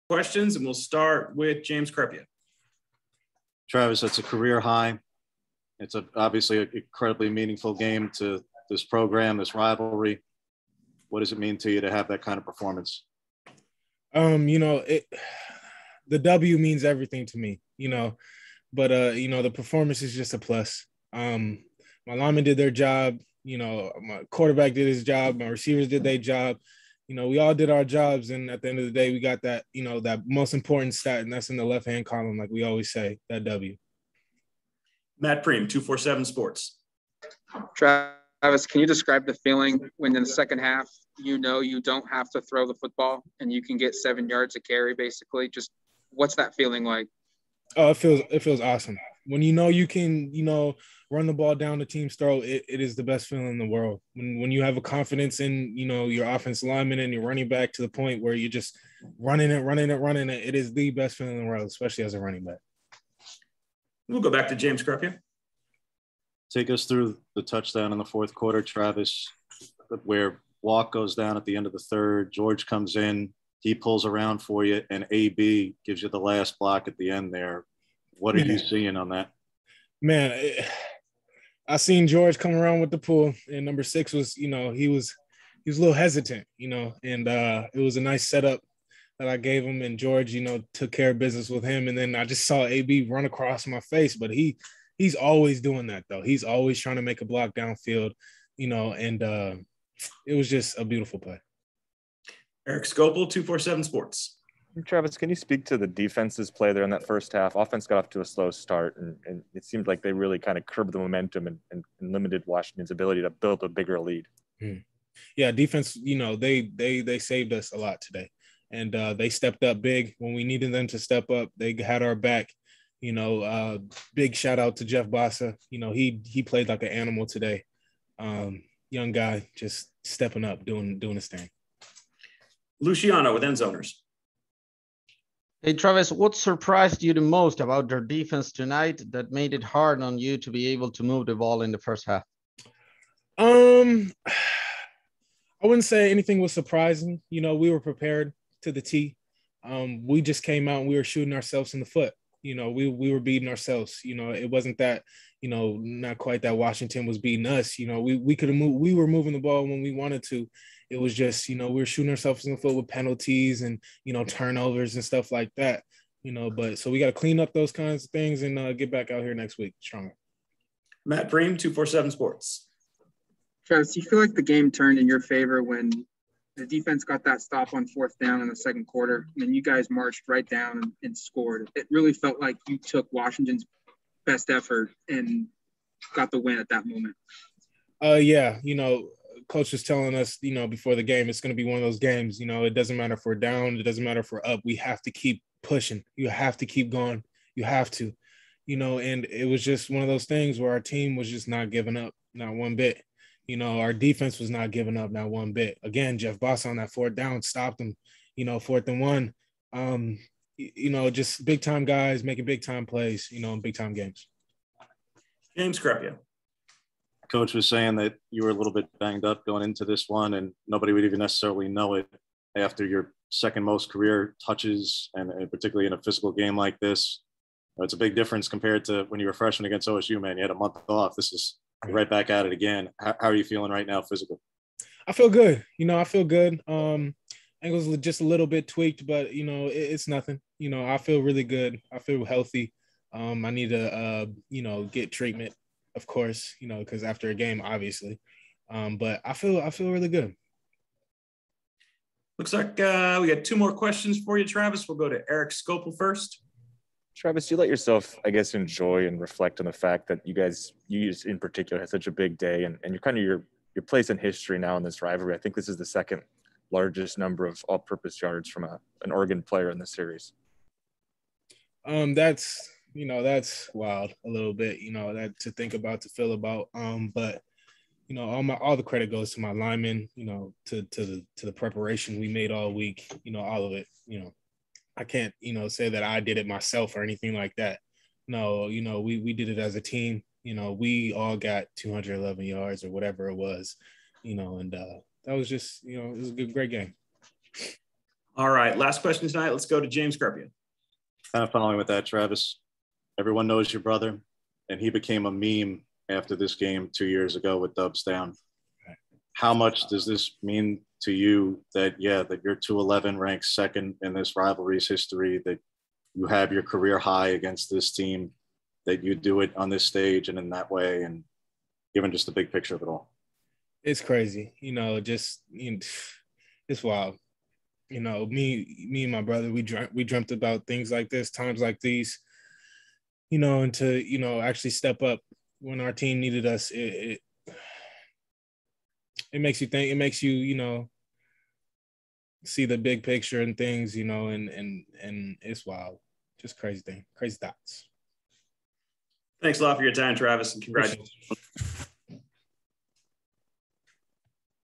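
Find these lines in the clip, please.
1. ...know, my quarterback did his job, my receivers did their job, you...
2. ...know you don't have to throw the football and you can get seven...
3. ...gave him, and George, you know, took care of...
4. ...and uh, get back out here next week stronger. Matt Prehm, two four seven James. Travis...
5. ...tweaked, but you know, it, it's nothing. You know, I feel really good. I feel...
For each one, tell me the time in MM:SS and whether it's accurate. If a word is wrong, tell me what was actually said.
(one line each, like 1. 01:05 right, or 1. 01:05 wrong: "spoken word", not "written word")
1. 00:23 right
2. 00:41 right
3. 01:29 right
4. 02:48 wrong: "Sports", not "James"
5. 03:58 right.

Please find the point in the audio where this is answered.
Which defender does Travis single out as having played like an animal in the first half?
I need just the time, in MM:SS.
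02:04.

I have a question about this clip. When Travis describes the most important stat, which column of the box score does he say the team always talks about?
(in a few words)
Left hand column.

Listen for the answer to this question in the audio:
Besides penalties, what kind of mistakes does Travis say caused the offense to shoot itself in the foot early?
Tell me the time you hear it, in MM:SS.
02:44.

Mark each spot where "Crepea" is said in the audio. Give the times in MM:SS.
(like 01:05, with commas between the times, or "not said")
00:01, 03:35.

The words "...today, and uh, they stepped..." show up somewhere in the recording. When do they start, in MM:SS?
01:57.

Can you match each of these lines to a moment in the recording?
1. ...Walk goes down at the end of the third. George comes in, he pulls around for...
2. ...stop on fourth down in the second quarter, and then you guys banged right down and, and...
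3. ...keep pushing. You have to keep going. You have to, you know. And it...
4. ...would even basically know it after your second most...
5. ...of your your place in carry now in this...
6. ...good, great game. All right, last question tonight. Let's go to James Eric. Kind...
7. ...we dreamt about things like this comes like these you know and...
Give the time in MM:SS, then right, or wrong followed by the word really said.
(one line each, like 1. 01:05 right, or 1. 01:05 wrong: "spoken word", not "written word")
1. 01:10 right
2. 02:57 wrong: "marched", not "banged"
3. 03:15 right
4. 03:40 wrong: "necessarily", not "basically"
5. 04:23 wrong: "history", not "carry"
6. 04:56 wrong: "Carpio", not "Eric"
7. 05:29 wrong: "times", not "comes".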